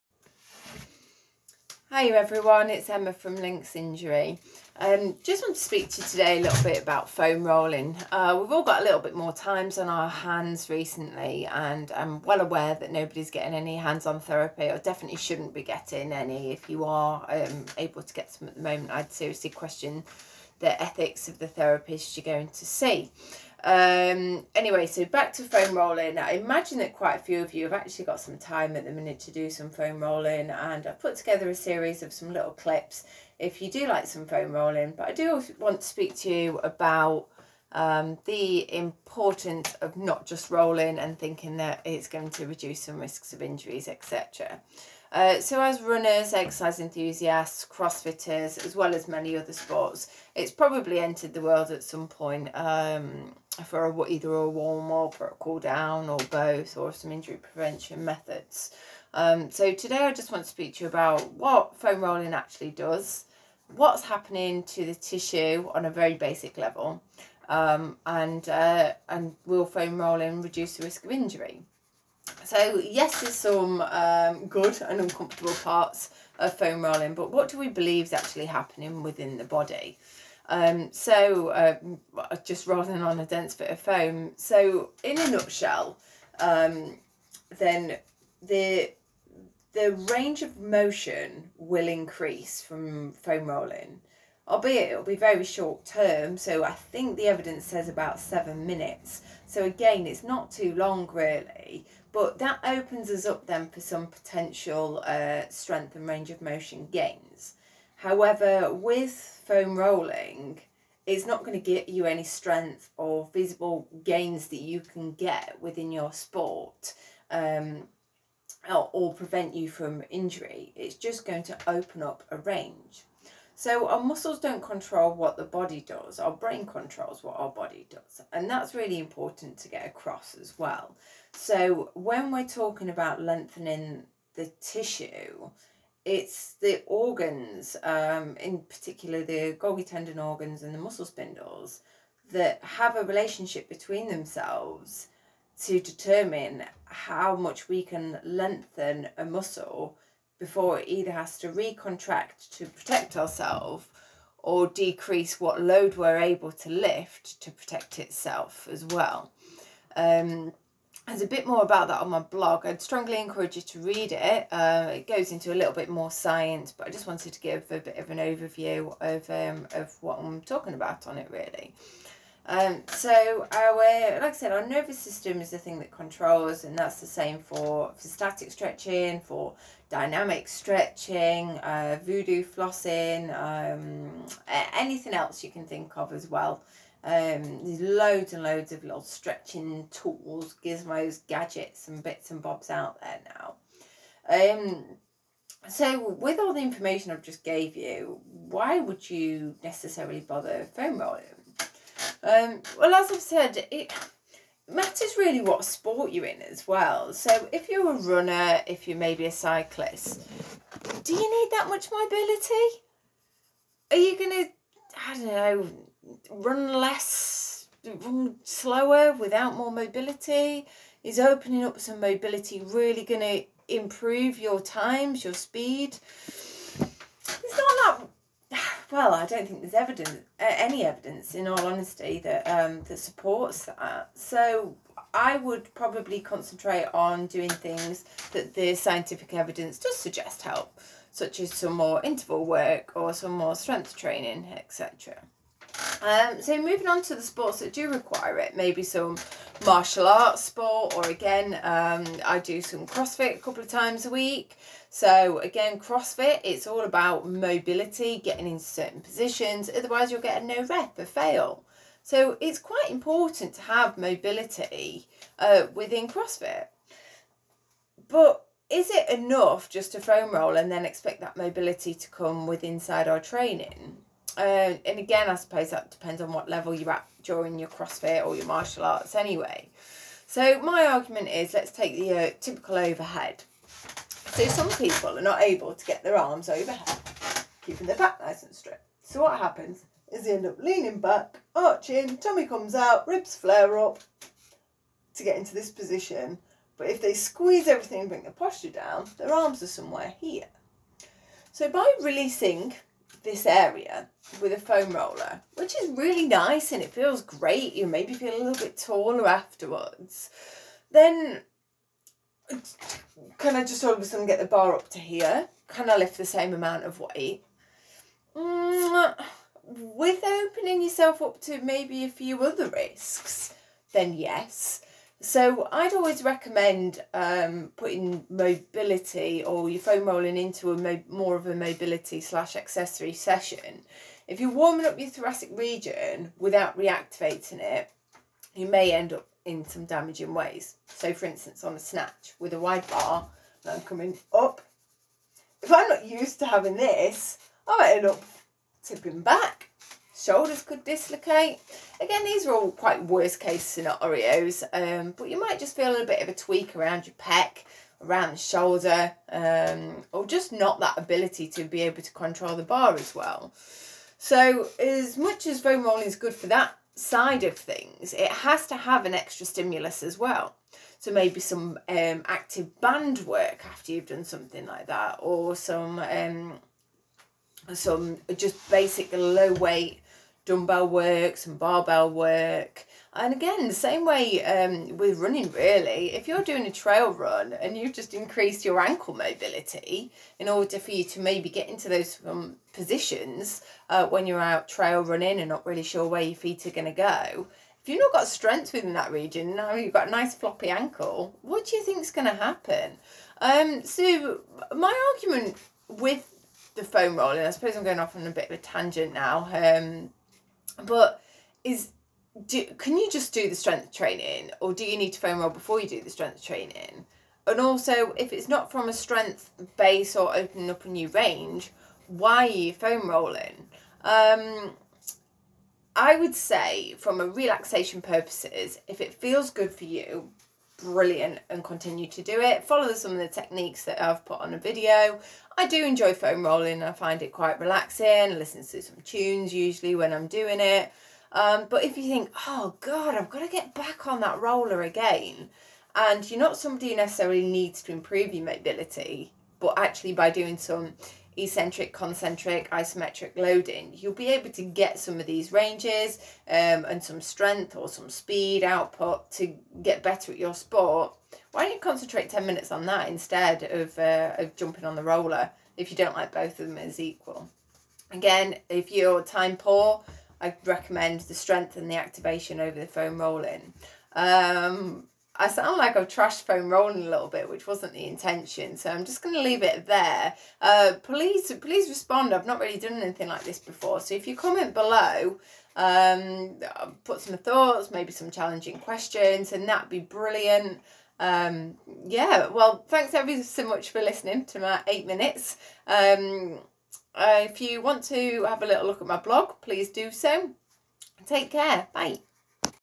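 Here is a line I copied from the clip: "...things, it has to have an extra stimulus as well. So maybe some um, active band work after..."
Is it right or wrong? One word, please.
right.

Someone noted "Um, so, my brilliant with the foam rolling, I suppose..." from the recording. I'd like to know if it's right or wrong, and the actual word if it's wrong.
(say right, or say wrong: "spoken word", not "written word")
wrong: "argument", not "brilliant".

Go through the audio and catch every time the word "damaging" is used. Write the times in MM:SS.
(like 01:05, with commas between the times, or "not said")
05:39.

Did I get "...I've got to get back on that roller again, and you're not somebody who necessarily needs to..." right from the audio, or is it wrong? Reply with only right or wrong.
right.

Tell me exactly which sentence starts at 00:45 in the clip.
Uh, so as runners, exercise enthusiasts, crossfitters, as well as many other sports, it's probably entered the world at some point.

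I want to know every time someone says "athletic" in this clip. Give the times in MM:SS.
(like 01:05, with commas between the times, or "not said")
not said.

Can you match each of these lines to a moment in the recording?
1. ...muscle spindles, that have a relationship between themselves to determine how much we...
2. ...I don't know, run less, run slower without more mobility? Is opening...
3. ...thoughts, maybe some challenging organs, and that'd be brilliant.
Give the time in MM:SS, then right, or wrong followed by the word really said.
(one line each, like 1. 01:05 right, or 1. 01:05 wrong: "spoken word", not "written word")
1. 02:20 right
2. 03:35 right
3. 08:07 wrong: "questions", not "organs".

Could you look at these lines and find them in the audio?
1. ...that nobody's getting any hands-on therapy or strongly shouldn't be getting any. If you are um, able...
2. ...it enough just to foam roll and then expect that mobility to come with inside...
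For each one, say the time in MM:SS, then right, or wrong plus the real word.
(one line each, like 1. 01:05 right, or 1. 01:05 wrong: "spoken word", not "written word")
1. 00:12 wrong: "definitely", not "strongly"
2. 04:28 right.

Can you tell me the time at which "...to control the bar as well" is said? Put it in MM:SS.
06:02.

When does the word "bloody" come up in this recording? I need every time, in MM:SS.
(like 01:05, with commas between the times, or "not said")
not said.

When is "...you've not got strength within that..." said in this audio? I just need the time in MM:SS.
06:37.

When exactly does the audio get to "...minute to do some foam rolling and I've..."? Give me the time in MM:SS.
00:28.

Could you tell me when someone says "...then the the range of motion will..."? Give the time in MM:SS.
01:27.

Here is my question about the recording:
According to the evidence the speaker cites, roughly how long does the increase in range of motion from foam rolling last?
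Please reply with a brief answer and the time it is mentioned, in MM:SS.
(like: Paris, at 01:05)
7 minutes, at 01:38.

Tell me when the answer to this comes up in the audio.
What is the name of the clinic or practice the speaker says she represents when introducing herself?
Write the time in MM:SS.
00:03.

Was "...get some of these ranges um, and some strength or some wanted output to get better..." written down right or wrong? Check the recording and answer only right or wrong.
wrong.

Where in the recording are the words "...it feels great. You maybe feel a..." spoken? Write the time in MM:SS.
05:06.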